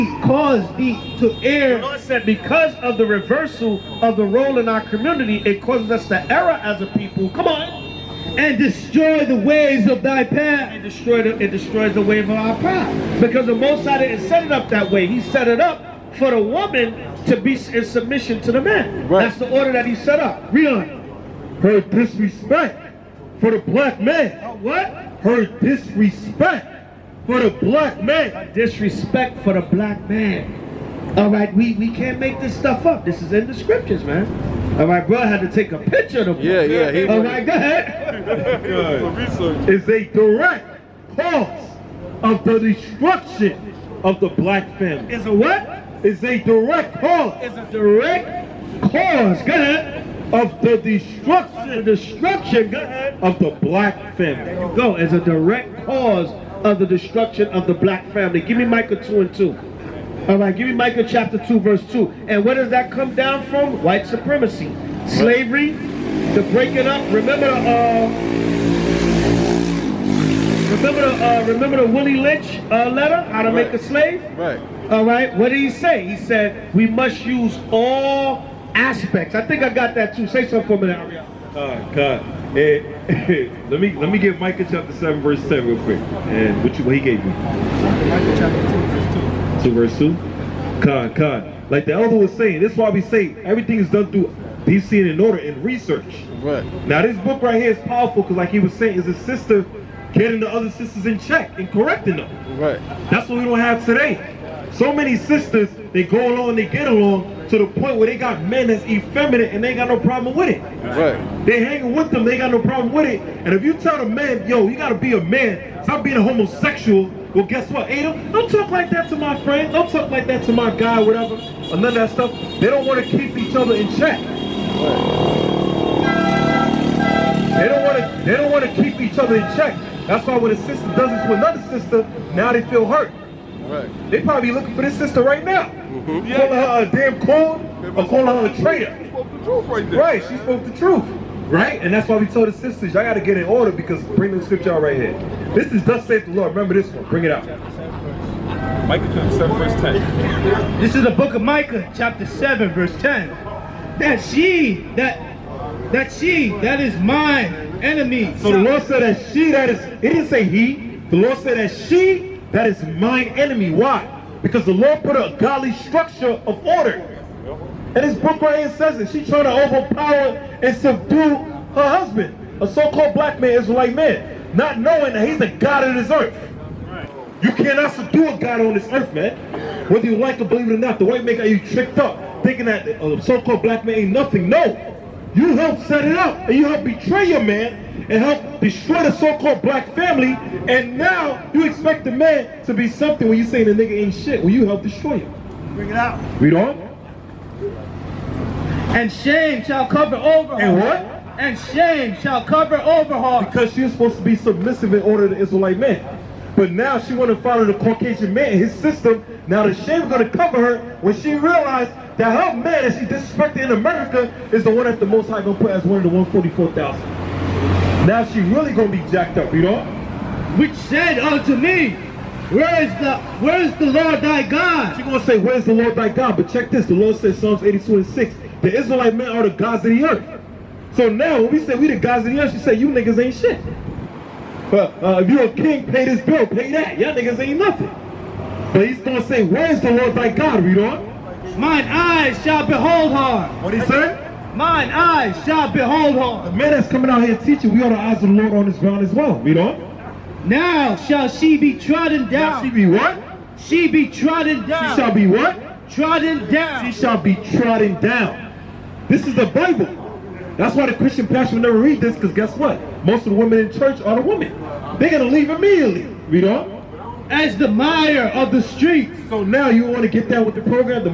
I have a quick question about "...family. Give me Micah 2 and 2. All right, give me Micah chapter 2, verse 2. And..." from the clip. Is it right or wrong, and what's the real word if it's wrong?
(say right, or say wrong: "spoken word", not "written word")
right.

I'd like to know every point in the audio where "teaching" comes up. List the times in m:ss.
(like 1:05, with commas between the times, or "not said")
4:07.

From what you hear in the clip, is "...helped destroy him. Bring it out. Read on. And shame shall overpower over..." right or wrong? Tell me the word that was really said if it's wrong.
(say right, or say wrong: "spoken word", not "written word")
wrong: "cover", not "overpower".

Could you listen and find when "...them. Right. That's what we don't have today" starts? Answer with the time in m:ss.
1:42.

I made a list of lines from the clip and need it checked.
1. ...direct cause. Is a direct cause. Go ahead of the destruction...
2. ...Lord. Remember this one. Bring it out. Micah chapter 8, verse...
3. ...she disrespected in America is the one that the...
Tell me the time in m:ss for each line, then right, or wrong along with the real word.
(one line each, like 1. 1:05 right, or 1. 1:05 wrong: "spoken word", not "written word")
1. 0:46 right
2. 2:26 wrong: "7", not "8"
3. 3:32 right.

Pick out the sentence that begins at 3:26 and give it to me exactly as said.
But now she want to follow the Caucasian man, his system.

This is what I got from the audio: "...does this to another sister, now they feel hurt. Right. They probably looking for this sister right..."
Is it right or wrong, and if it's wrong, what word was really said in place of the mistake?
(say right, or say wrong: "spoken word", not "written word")
right.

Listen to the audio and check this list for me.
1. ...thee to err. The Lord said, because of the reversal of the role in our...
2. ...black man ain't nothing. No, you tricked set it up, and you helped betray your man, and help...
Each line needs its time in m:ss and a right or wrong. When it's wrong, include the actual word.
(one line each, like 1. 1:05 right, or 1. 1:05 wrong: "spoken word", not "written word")
1. 0:00 right
2. 3:03 wrong: "helped", not "tricked".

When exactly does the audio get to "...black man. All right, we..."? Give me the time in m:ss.
0:29.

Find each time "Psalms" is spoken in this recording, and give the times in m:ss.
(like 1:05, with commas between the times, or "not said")
3:47.